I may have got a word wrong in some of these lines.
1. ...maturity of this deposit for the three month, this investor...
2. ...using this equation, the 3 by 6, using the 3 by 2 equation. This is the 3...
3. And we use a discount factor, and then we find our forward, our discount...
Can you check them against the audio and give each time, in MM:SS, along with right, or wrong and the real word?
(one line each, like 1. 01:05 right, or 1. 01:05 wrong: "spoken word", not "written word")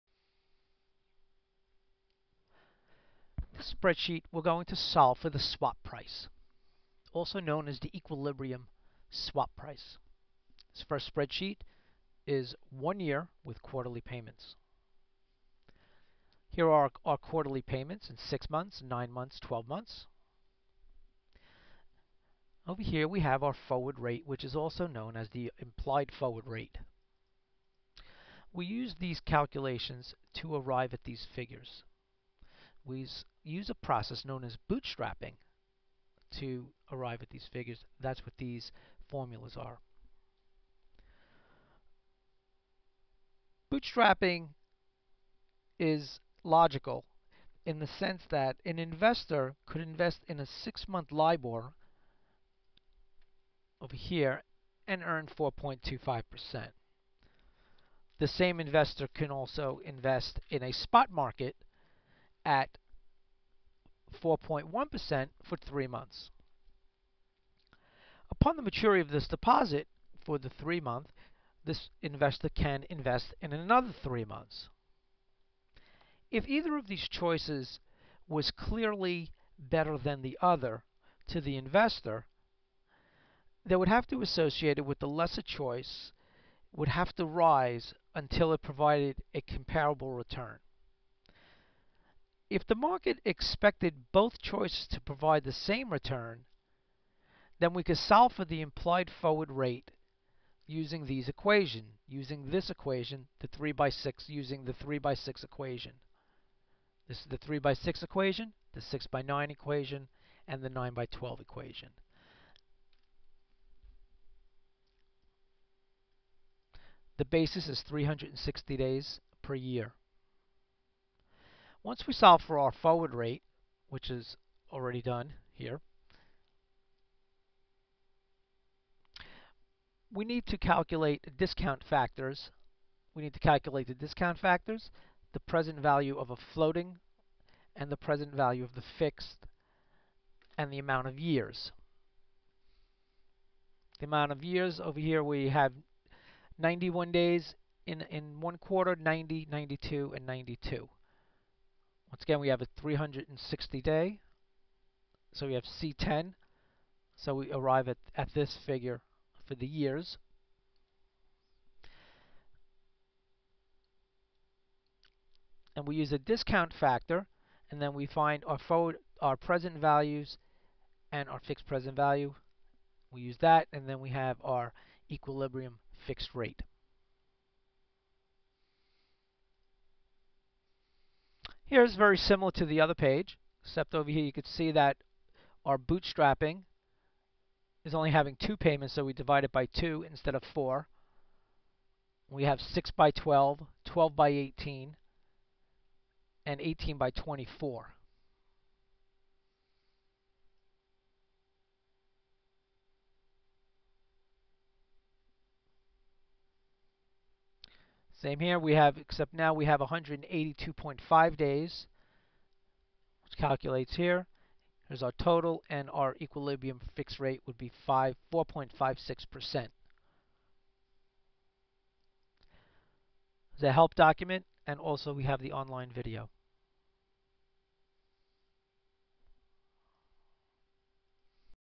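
1. 01:08 right
2. 01:42 wrong: "6", not "2"
3. 02:45 wrong: "present", not "discount".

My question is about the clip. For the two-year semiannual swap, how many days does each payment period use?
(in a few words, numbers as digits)
182.5.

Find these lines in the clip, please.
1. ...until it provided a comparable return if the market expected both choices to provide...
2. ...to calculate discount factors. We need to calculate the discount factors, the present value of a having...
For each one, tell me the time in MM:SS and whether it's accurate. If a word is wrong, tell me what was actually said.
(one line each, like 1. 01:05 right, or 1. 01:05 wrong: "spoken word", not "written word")
1. 01:28 right
2. 02:10 wrong: "floating", not "having".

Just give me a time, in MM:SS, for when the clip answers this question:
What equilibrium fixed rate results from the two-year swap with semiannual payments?
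03:38.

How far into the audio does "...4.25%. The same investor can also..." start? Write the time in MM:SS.
00:55.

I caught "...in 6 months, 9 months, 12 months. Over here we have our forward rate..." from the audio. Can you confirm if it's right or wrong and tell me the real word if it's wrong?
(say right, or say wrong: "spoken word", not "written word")
right.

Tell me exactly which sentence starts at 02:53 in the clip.
We use that, and then we have our equilibrium fixed rate.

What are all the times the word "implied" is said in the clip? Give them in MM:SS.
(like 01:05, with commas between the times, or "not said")
00:25, 01:38.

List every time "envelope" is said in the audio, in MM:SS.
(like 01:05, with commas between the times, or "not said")
not said.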